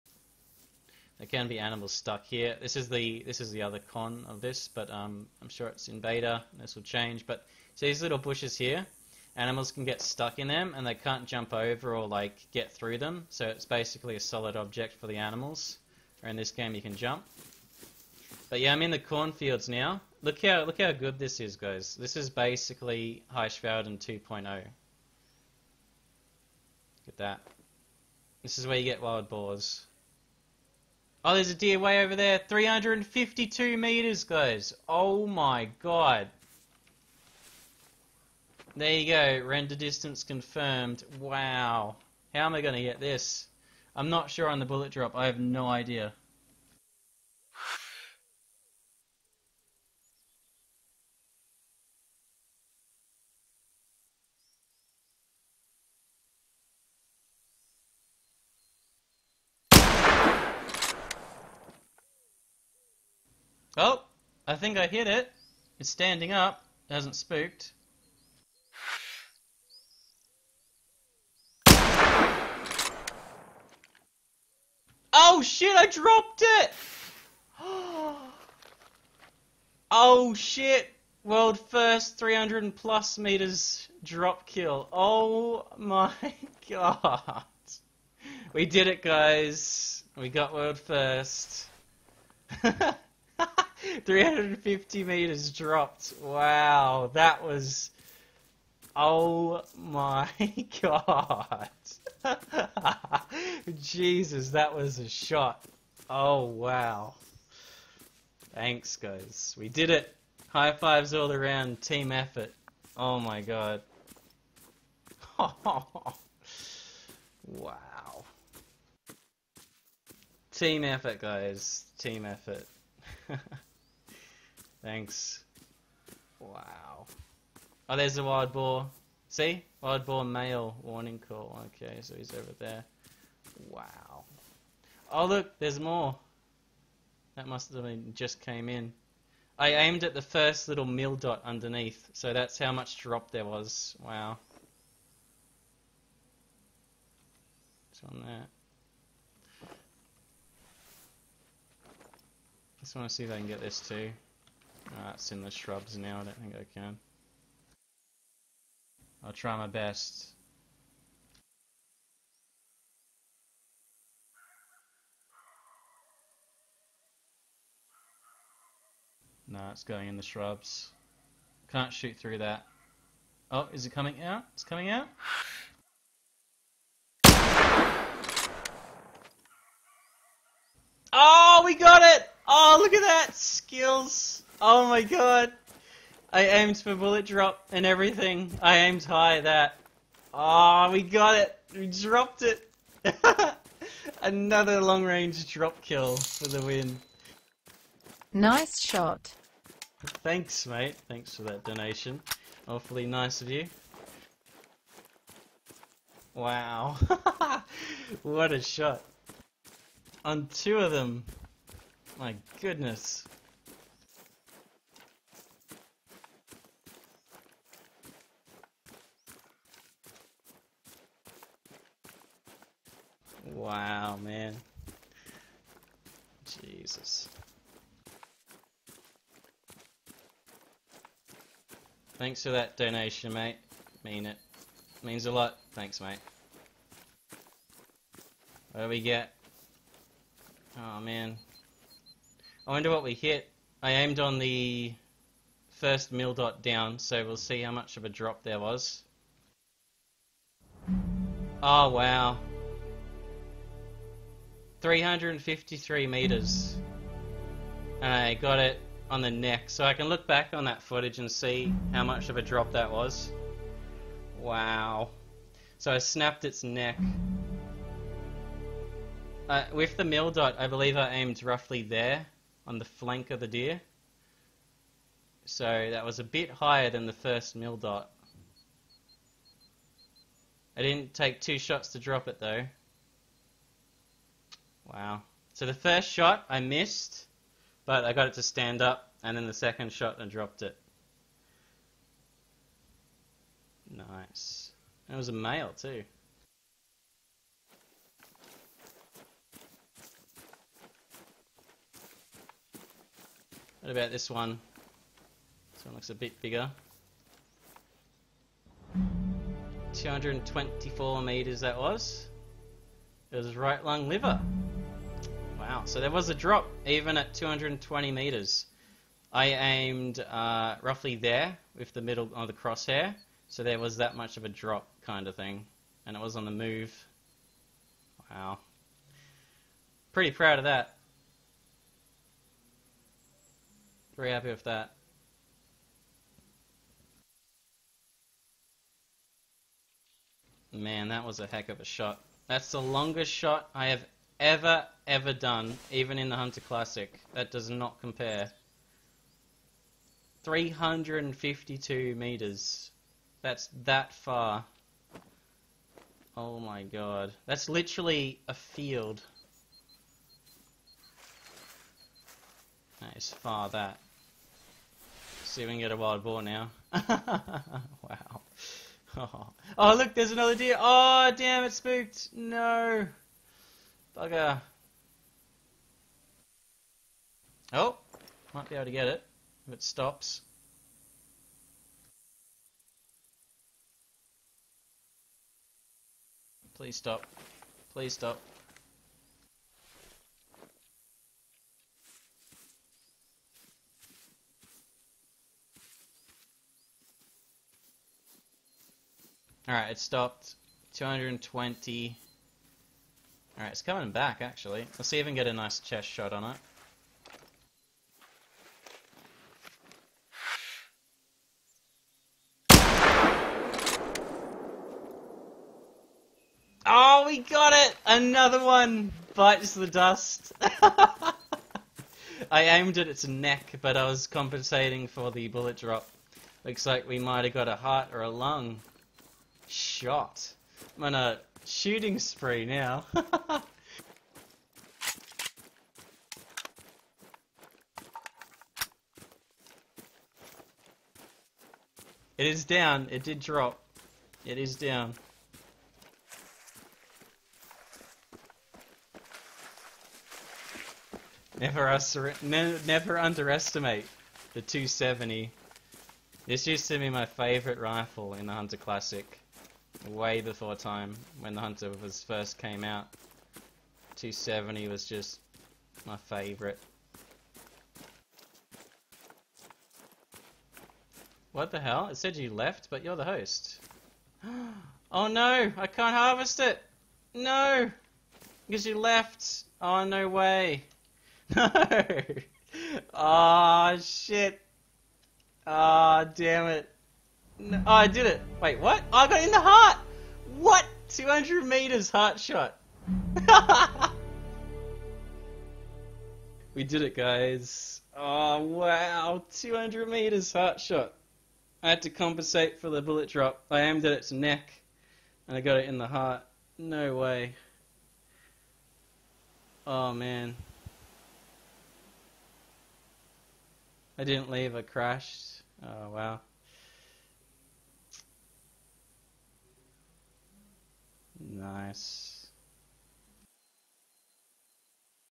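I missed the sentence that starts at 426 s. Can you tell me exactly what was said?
Looks like we might have got a heart or a lung shot.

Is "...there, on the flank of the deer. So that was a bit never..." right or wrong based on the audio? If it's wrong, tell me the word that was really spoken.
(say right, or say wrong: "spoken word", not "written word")
wrong: "higher", not "never".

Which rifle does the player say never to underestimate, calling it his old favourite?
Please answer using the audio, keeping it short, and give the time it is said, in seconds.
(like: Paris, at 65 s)
the 270, at 454 s.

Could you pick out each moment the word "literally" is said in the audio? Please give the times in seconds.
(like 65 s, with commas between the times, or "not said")
357 s.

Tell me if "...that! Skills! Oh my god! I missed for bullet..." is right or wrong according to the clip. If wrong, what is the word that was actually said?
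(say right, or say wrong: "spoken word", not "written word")
wrong: "aimed", not "missed".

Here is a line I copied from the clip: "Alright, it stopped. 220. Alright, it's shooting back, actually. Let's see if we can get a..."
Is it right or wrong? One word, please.
wrong.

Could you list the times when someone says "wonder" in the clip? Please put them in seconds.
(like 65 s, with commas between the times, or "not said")
242 s.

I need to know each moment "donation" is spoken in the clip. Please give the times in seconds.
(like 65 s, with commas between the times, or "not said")
201 s, 232 s.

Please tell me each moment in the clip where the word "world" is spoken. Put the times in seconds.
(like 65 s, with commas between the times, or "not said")
81 s, 90 s.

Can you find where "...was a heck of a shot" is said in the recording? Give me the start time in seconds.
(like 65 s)
341 s.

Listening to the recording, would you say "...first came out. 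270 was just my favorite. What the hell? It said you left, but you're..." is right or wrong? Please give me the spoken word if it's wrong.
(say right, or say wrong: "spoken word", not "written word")
right.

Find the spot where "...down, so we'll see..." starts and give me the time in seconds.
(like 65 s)
246 s.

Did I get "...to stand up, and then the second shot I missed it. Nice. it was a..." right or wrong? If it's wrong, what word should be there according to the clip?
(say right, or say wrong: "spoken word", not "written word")
wrong: "dropped", not "missed".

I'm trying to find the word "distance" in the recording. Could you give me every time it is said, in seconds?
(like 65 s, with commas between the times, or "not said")
39 s.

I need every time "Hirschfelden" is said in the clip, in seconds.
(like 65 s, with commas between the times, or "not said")
23 s.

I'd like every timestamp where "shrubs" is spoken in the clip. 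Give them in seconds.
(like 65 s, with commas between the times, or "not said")
155 s, 170 s.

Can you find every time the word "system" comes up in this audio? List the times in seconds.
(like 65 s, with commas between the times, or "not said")
not said.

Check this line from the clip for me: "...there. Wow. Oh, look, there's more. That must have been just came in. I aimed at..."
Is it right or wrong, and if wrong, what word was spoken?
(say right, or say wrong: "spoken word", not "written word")
right.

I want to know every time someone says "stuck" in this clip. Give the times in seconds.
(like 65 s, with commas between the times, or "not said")
1 s, 10 s.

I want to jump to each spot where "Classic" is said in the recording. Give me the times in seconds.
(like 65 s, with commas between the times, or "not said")
346 s, 458 s.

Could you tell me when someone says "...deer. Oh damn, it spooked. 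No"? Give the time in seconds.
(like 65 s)
370 s.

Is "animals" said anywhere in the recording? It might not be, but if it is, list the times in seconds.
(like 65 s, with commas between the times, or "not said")
1 s, 9 s, 15 s.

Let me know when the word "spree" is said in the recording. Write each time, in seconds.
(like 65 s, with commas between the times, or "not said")
432 s.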